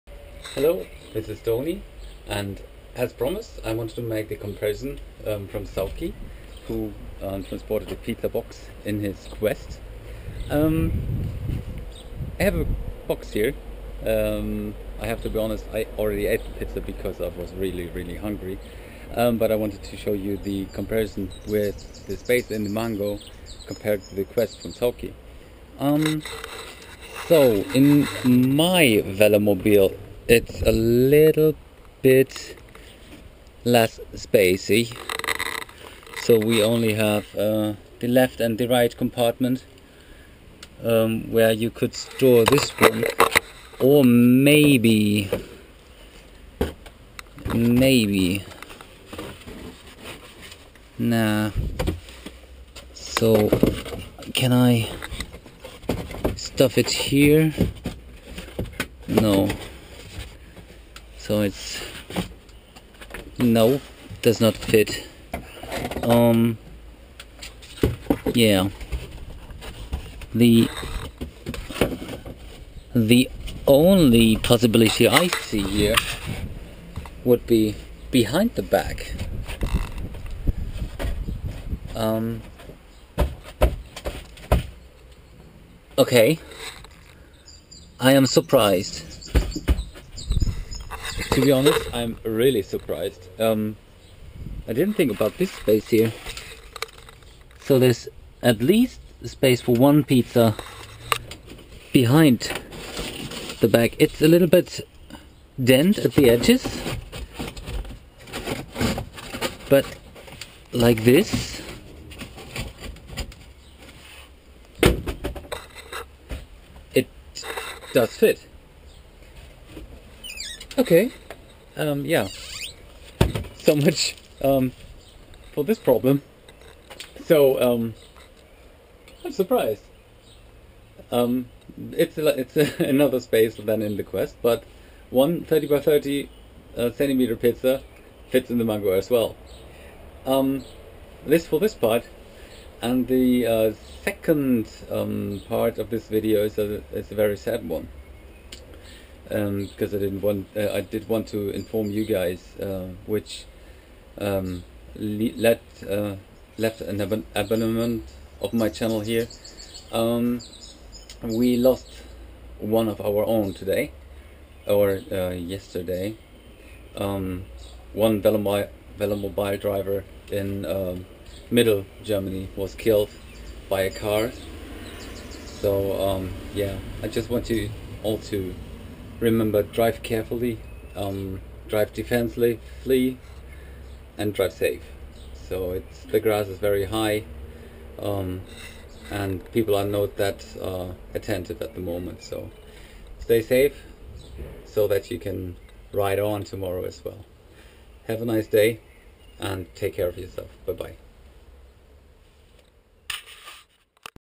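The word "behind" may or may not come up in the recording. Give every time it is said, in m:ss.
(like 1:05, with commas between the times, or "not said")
1:18, 1:41.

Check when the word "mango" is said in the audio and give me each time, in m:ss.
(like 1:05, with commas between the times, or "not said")
0:22, 2:18.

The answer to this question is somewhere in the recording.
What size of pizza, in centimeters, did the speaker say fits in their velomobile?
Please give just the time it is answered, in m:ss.
2:15.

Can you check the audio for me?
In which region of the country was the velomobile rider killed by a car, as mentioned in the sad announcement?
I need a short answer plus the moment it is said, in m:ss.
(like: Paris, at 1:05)
Middle Germany, at 2:51.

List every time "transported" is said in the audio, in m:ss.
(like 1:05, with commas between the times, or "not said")
0:07.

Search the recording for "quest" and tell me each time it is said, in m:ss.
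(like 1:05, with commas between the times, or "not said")
0:09, 0:24, 2:14.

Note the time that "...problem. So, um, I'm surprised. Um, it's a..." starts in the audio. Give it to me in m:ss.
2:05.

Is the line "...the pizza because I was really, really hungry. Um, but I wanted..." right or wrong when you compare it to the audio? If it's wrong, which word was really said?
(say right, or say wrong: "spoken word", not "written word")
right.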